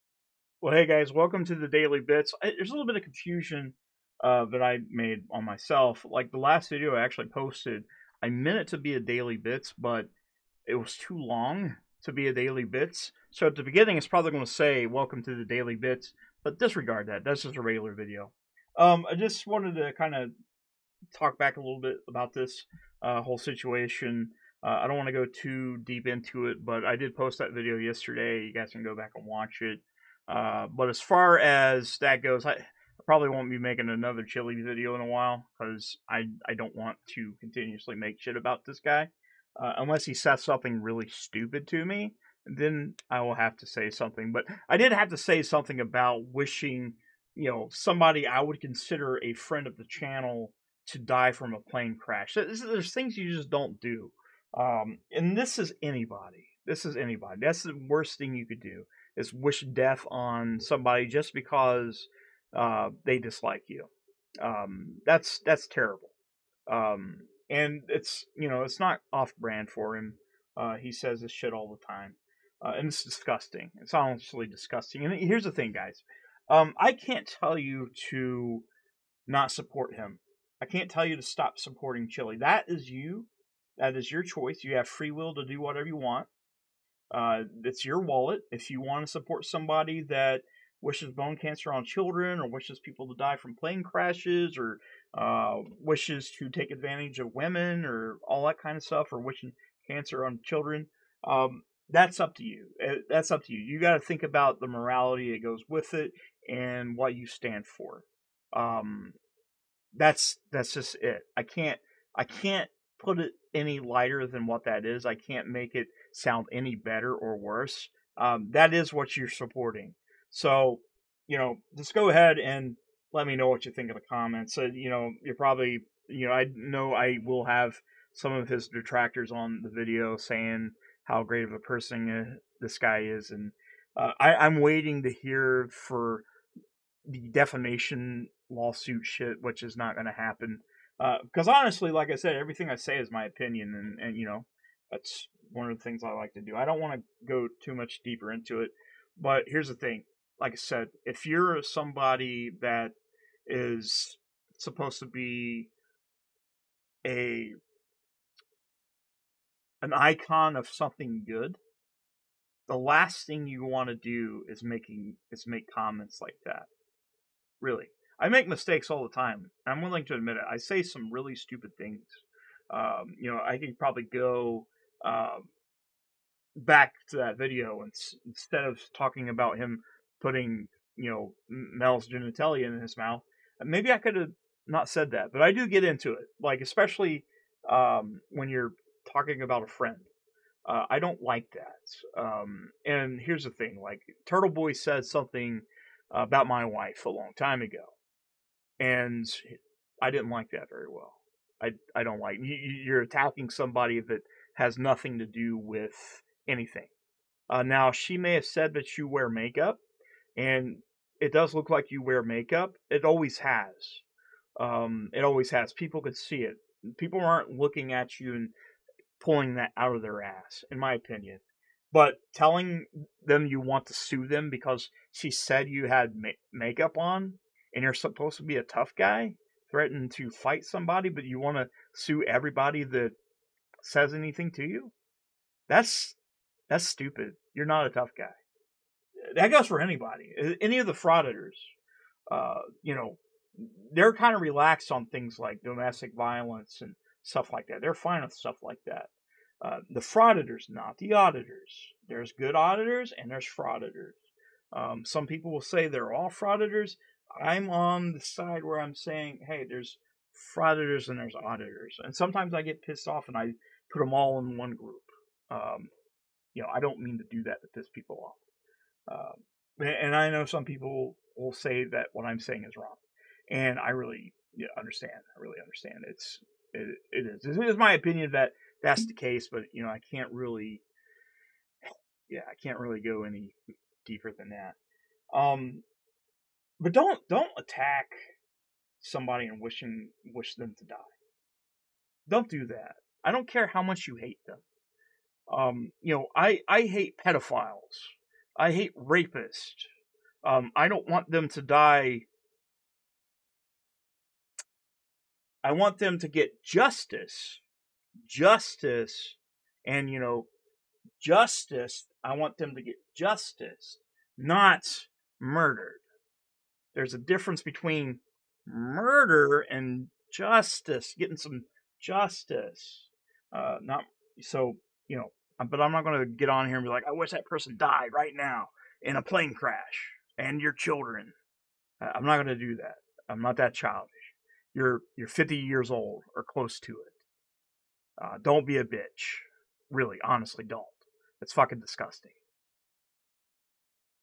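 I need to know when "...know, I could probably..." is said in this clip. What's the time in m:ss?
2:53.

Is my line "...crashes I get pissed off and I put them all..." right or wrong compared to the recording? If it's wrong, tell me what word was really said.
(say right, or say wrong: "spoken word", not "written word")
wrong: "sometimes", not "crashes".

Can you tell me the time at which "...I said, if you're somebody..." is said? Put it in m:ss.
2:30.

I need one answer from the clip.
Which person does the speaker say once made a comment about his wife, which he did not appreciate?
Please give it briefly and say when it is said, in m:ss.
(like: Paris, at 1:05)
Turtle Boy, at 3:14.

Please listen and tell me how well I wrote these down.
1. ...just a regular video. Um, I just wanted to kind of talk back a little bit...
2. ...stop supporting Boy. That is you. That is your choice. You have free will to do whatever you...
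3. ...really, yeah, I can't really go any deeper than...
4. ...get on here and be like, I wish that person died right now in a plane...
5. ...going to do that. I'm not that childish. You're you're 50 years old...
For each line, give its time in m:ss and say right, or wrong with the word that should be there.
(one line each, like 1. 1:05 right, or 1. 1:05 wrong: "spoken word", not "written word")
1. 0:17 right
2. 1:21 wrong: "Chille", not "Boy"
3. 4:40 right
4. 5:26 right
5. 5:32 right.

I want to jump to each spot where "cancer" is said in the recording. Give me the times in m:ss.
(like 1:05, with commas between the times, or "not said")
1:31, 1:39.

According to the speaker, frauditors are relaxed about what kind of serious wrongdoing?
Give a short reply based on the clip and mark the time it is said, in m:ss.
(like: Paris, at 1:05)
domestic violence, at 4:05.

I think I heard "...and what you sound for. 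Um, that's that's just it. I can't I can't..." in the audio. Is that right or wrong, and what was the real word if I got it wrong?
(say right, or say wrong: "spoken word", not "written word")
wrong: "stand", not "sound".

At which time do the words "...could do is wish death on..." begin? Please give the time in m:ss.
0:58.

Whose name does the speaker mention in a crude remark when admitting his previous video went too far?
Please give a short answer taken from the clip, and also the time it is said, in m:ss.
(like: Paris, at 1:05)
Mel, at 3:01.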